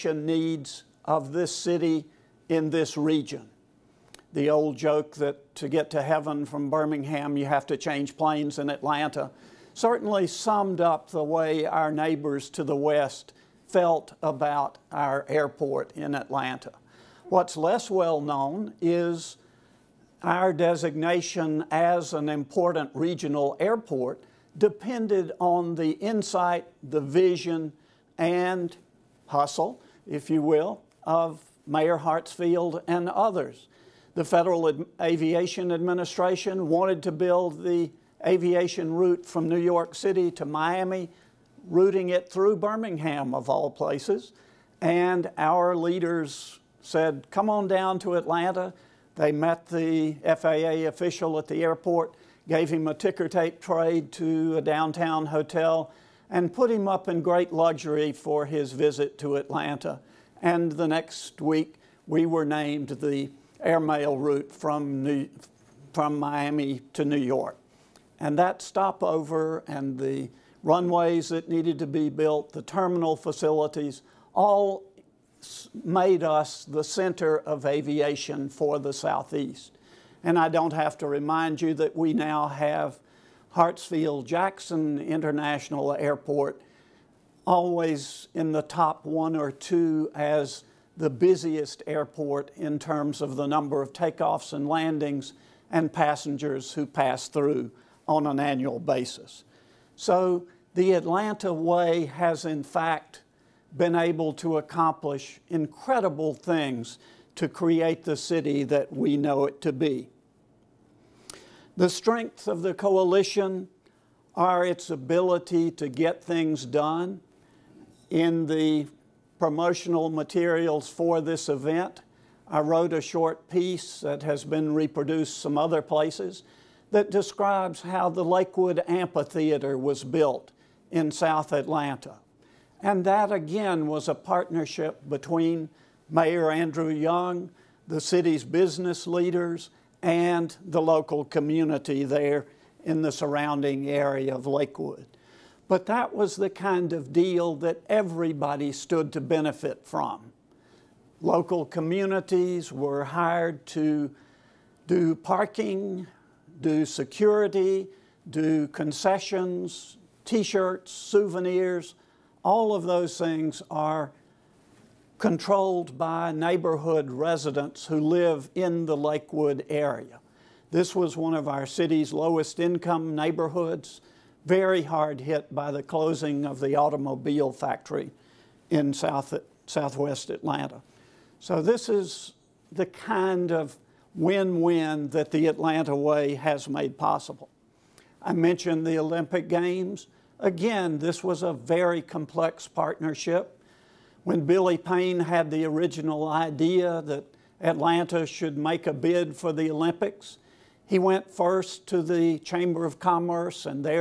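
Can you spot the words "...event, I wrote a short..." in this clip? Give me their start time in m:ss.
2:01.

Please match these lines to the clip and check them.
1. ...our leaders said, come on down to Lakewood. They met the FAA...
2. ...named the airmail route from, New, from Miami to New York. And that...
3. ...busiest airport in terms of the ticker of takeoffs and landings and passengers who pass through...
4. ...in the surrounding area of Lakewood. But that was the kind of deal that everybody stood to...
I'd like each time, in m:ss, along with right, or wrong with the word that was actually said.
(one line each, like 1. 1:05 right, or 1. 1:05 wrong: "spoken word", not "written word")
1. 0:45 wrong: "Atlanta", not "Lakewood"
2. 1:02 right
3. 1:31 wrong: "number", not "ticker"
4. 2:22 right.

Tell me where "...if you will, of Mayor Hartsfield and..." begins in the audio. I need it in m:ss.
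0:30.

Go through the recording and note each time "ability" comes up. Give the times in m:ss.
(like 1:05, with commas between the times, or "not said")
1:54.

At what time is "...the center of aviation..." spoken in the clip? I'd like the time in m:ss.
1:16.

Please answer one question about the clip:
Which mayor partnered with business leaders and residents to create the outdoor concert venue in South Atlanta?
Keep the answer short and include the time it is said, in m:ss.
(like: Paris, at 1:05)
Andrew Young, at 2:16.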